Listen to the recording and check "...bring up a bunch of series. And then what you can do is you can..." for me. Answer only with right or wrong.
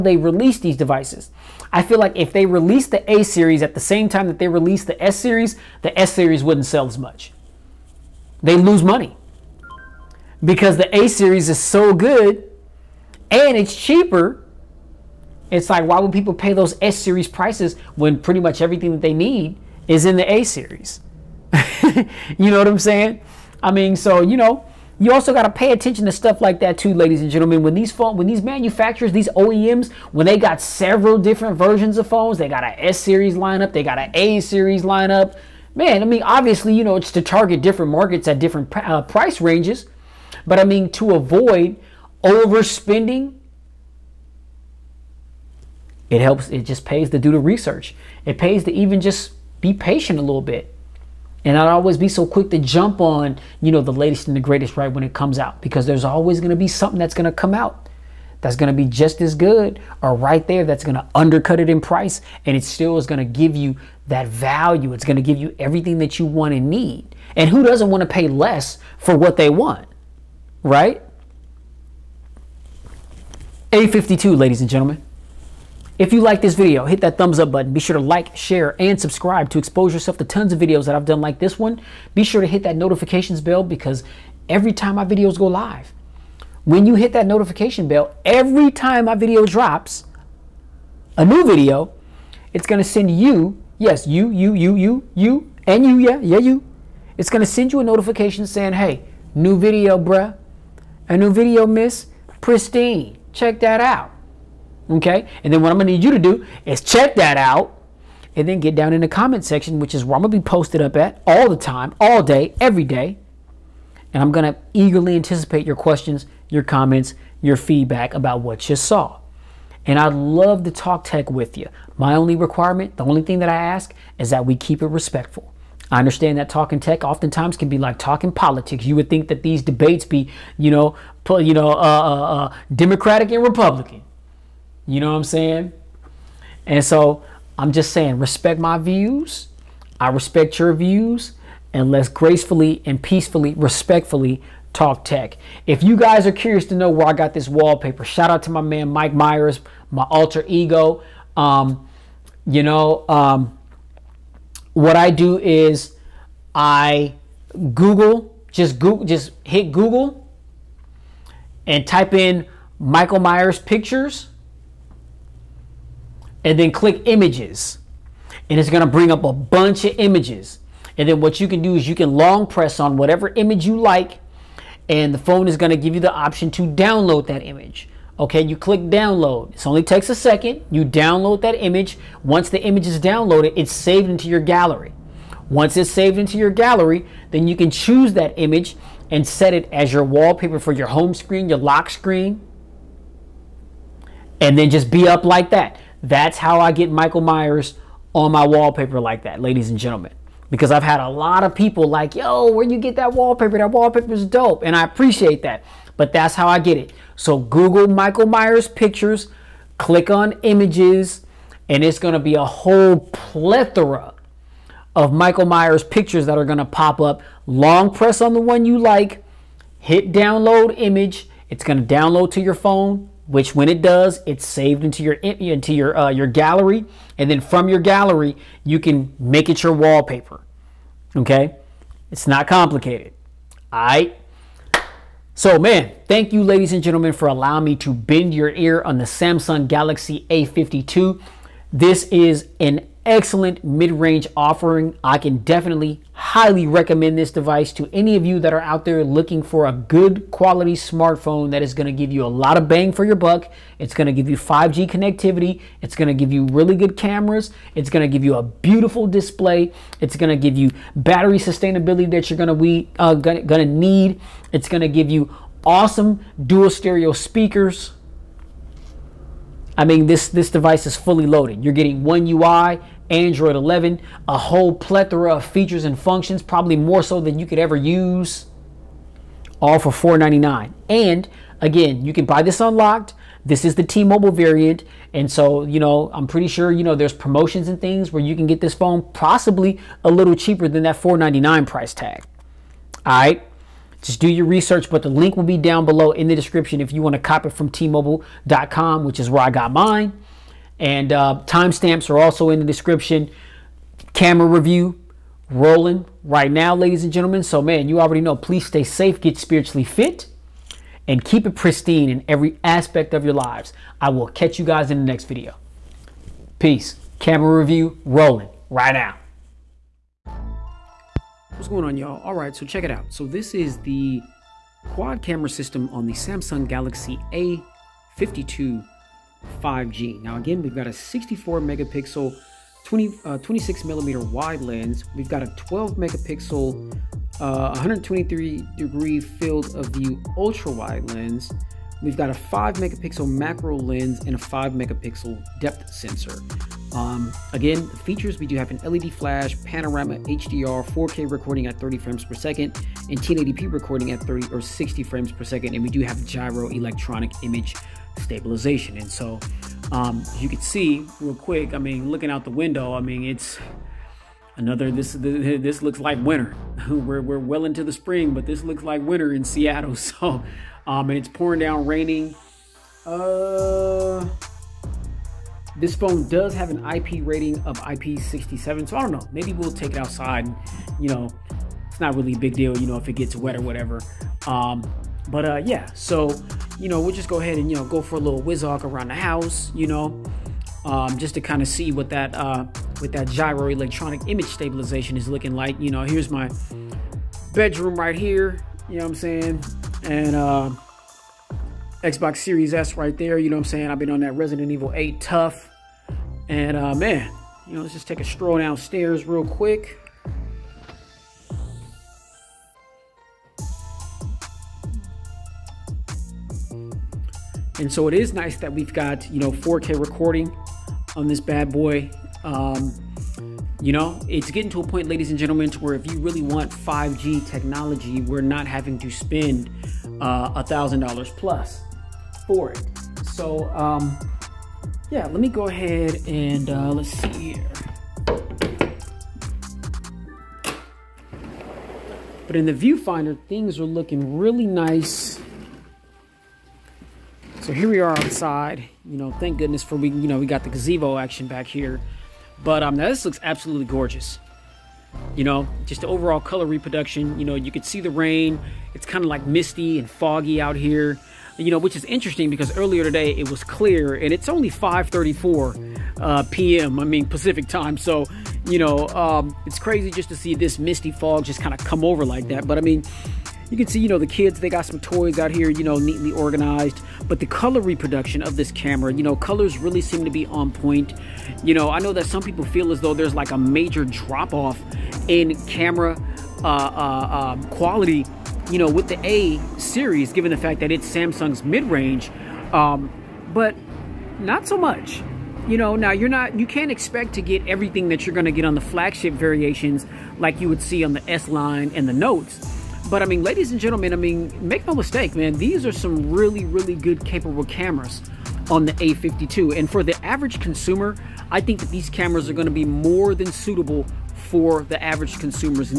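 wrong.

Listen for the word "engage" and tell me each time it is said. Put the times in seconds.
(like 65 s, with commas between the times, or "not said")
not said.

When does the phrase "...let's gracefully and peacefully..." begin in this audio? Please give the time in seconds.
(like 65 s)
141 s.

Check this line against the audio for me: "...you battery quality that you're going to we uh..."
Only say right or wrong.
wrong.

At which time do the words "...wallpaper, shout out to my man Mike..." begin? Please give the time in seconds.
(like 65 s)
147 s.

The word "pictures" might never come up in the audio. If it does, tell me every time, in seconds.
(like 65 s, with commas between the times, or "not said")
163 s, 208 s, 215 s.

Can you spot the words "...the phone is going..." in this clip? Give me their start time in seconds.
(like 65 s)
175 s.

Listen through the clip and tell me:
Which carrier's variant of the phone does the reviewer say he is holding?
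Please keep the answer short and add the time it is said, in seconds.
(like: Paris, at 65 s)
T-Mobile, at 283 s.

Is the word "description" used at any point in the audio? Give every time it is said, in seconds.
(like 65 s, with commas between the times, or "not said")
296 s, 302 s.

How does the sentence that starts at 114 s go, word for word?
And I'm going to eagerly anticipate your questions, your comments, your feedback about what you saw.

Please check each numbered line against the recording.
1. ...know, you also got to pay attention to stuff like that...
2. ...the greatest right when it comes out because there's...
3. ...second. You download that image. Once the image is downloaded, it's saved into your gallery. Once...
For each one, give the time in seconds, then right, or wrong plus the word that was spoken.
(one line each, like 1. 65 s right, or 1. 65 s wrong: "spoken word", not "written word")
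1. 24 s right
2. 54 s right
3. 180 s right.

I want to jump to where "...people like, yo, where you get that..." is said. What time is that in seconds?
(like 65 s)
201 s.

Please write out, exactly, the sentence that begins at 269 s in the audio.
I mean, this, this device is fully loaded.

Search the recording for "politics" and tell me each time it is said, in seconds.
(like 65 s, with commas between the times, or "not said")
128 s.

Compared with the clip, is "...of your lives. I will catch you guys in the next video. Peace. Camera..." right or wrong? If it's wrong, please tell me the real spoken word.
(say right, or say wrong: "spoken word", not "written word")
right.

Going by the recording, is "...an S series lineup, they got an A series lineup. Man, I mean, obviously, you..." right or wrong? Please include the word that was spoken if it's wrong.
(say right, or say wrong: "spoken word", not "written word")
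right.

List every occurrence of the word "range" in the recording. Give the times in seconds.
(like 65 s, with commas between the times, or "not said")
39 s, 243 s, 491 s.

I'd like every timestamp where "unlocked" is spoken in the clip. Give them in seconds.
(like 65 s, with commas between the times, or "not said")
282 s.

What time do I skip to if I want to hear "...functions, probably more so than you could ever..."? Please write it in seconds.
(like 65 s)
275 s.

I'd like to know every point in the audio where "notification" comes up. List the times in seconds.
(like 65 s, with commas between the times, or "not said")
82 s, 87 s, 97 s.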